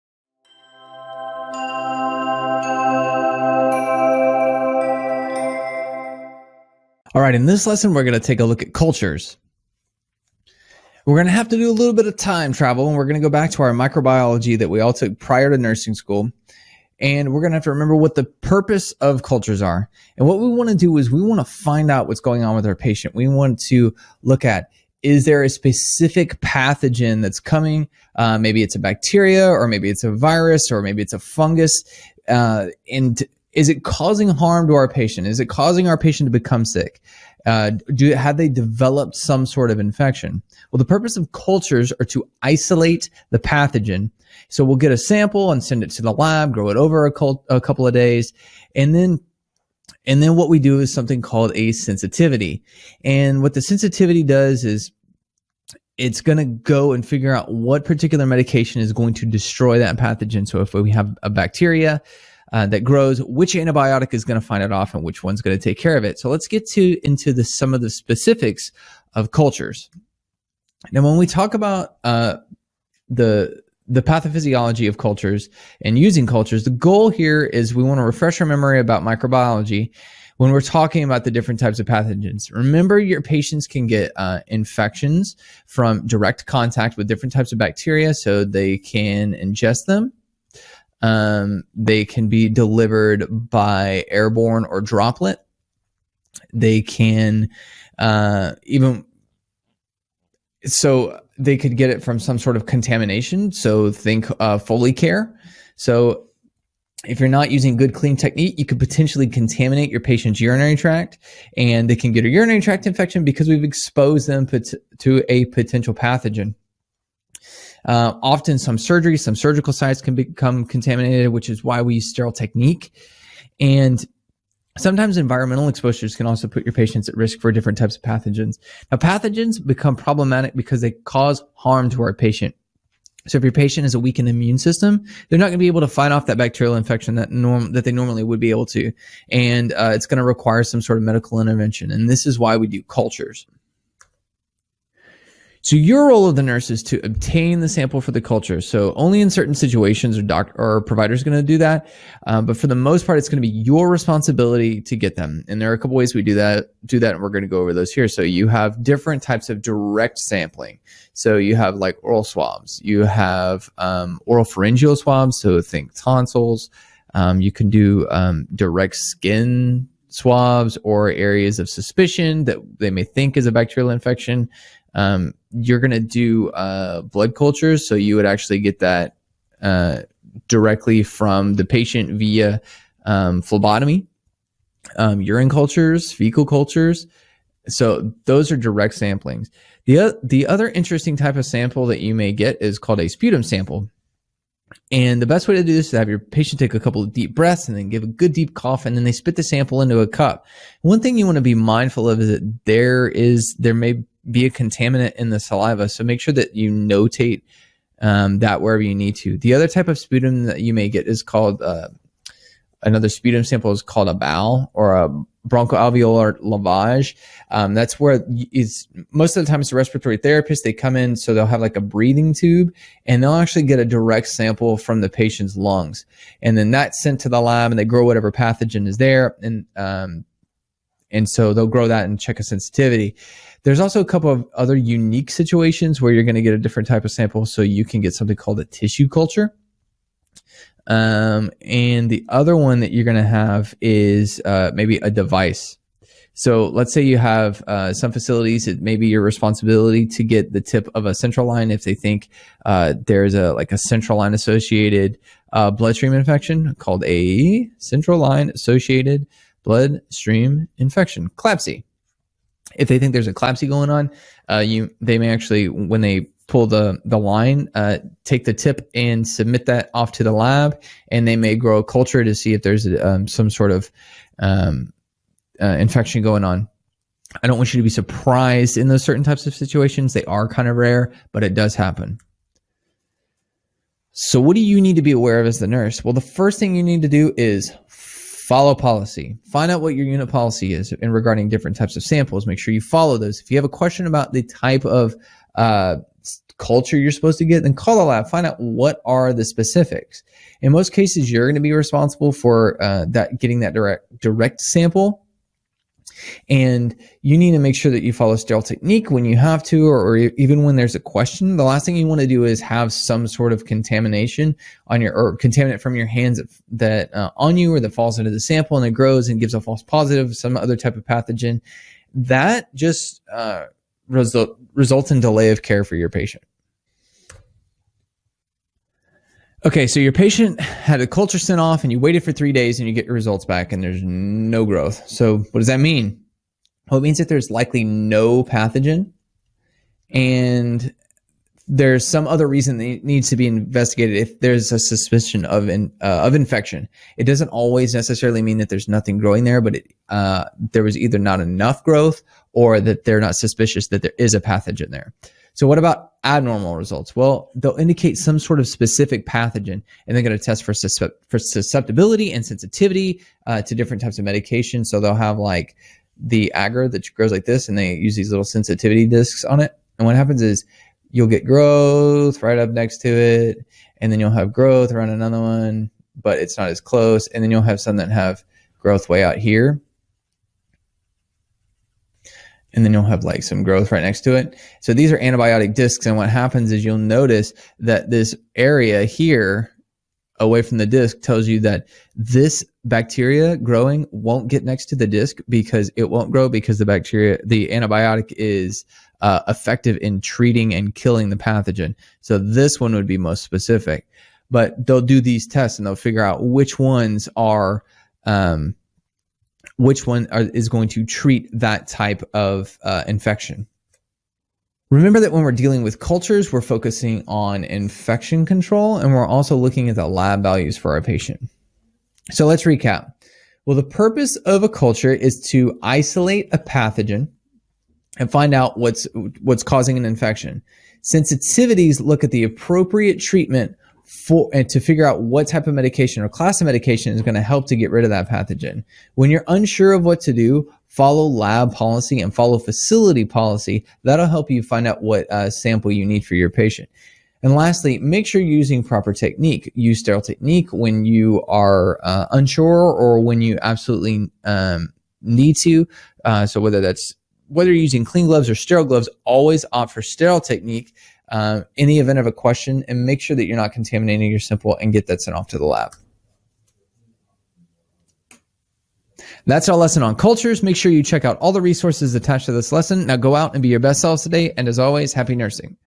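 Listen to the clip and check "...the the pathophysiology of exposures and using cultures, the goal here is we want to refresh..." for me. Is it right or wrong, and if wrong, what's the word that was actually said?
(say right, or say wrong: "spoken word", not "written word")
wrong: "cultures", not "exposures".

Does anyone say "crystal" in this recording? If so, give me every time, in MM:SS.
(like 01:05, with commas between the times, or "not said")
not said.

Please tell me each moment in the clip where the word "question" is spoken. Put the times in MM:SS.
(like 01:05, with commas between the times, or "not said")
04:53, 05:10, 07:42.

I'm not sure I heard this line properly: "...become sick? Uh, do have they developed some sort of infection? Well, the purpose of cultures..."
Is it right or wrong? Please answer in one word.
right.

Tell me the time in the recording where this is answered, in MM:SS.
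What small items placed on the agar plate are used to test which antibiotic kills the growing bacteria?
06:08.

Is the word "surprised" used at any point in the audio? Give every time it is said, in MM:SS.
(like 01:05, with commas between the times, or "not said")
04:37.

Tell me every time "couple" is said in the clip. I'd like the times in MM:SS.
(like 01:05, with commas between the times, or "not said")
00:47, 02:35, 03:16, 03:54.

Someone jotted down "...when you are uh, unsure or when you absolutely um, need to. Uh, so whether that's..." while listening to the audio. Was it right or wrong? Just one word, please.
right.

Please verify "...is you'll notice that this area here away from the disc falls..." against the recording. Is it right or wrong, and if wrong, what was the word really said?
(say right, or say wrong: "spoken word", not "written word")
wrong: "tells", not "falls".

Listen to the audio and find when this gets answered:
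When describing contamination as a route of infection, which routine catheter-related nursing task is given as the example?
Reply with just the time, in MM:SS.
01:44.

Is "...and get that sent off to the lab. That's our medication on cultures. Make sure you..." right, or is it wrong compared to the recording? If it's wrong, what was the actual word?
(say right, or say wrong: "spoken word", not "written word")
wrong: "lesson", not "medication".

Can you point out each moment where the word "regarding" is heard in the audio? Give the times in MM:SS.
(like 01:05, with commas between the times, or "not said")
04:51.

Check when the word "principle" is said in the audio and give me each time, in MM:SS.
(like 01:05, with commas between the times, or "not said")
not said.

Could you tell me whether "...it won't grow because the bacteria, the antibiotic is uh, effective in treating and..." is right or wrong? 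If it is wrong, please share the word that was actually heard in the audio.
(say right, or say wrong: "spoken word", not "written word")
right.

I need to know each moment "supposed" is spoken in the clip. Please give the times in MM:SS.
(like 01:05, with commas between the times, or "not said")
04:57.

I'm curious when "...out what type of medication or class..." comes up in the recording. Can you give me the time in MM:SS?
07:15.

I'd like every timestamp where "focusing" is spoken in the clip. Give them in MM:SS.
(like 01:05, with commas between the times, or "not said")
06:56.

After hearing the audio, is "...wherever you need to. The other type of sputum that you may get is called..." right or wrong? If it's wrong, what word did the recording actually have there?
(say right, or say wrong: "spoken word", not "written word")
right.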